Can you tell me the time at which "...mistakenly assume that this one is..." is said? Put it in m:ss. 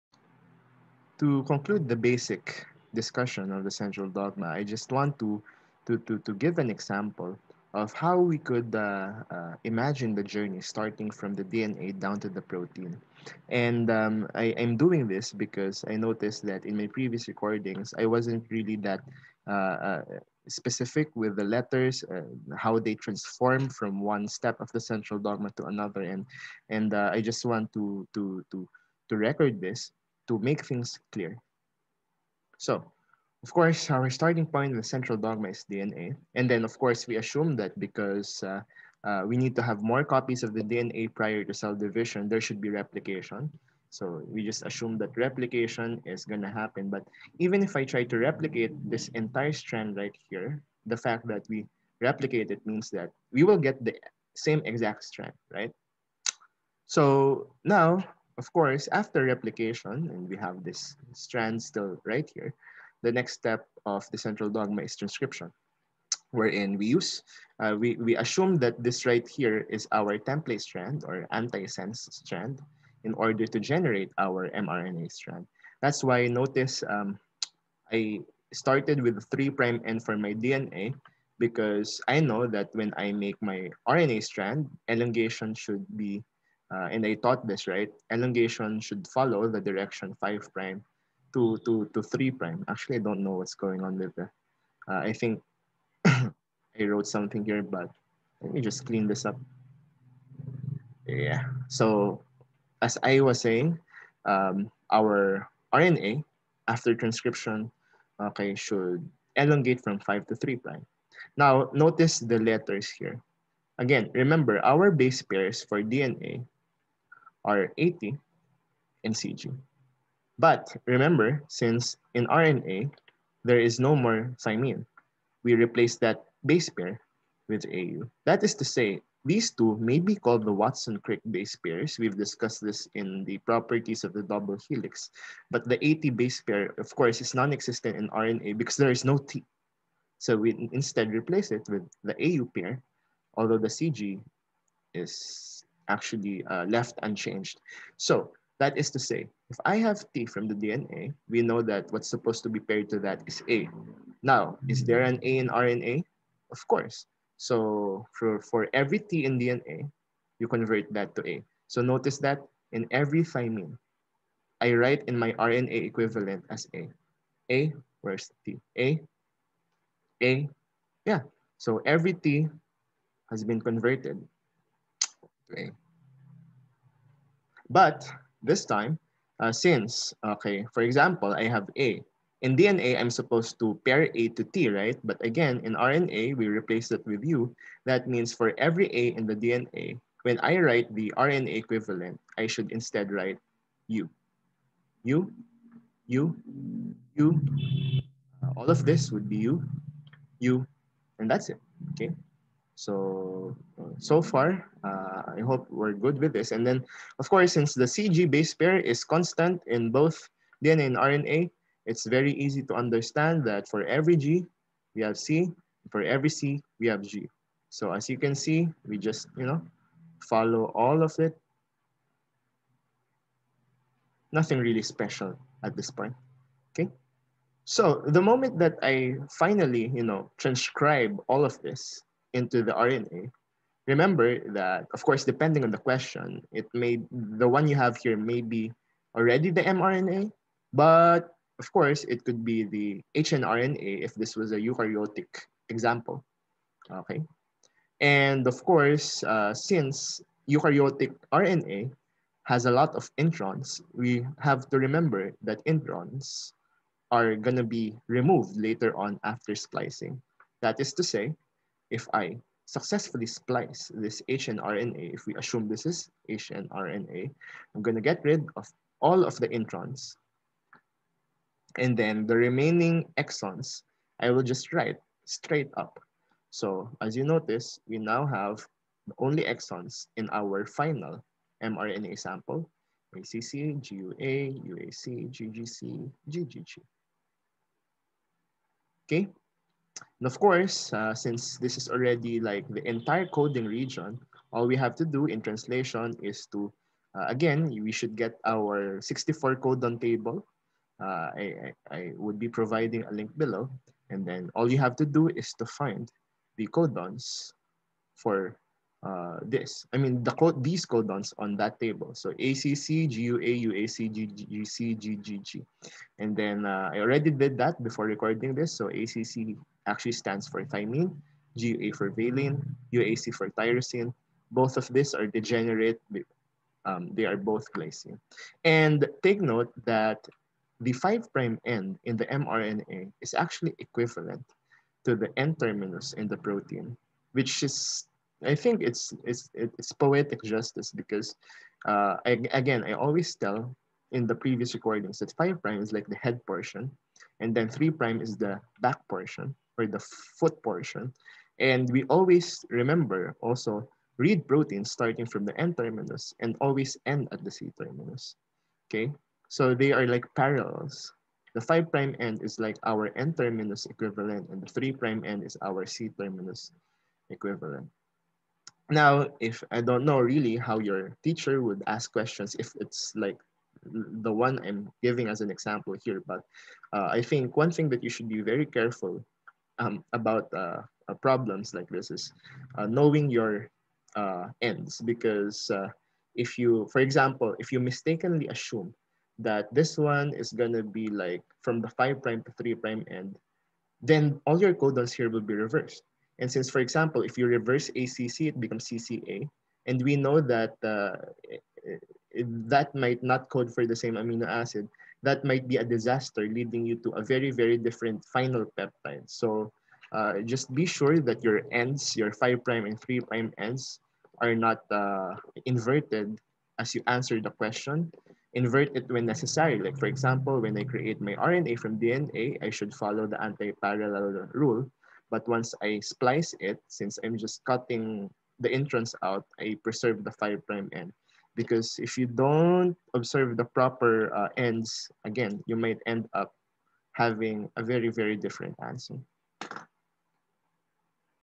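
6:27.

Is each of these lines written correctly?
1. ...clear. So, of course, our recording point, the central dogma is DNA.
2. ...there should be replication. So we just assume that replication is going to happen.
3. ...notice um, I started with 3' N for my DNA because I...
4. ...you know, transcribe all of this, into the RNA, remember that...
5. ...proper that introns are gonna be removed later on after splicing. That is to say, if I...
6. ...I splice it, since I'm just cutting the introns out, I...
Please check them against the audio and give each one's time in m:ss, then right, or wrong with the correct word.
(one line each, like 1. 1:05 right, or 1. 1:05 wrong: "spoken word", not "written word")
1. 0:31 wrong: "starting", not "recording"
2. 0:42 right
3. 1:16 right
4. 3:49 right
5. 4:14 wrong: "remember", not "proper"
6. 7:05 right.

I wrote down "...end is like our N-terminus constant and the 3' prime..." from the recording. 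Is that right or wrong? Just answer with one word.
wrong.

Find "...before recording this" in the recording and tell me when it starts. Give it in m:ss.
5:17.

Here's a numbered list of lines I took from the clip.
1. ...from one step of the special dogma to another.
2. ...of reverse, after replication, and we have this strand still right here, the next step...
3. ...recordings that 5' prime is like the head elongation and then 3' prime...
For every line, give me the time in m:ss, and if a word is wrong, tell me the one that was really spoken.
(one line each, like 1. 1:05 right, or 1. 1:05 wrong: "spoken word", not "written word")
1. 0:23 wrong: "central", not "special"
2. 0:58 wrong: "course", not "reverse"
3. 5:44 wrong: "portion", not "elongation".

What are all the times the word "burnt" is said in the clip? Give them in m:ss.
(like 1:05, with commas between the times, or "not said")
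not said.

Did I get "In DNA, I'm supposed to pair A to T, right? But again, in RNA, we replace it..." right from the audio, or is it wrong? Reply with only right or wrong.
right.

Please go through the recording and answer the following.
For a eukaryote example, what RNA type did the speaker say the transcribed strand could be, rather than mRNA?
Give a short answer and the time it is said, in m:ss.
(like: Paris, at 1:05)
hnRNA, at 4:03.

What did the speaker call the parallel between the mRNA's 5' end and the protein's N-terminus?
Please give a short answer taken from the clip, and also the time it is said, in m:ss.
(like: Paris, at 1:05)
Poetic justice, at 5:39.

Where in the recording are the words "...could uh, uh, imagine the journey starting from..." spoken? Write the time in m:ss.
0:08.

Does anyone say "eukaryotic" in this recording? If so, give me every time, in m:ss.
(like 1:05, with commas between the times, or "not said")
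4:04, 4:10.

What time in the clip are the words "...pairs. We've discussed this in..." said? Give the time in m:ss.
2:11.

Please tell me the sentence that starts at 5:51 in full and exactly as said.
And we always remember also read proteins starting from the N-terminus and always end at the C-terminus, okay?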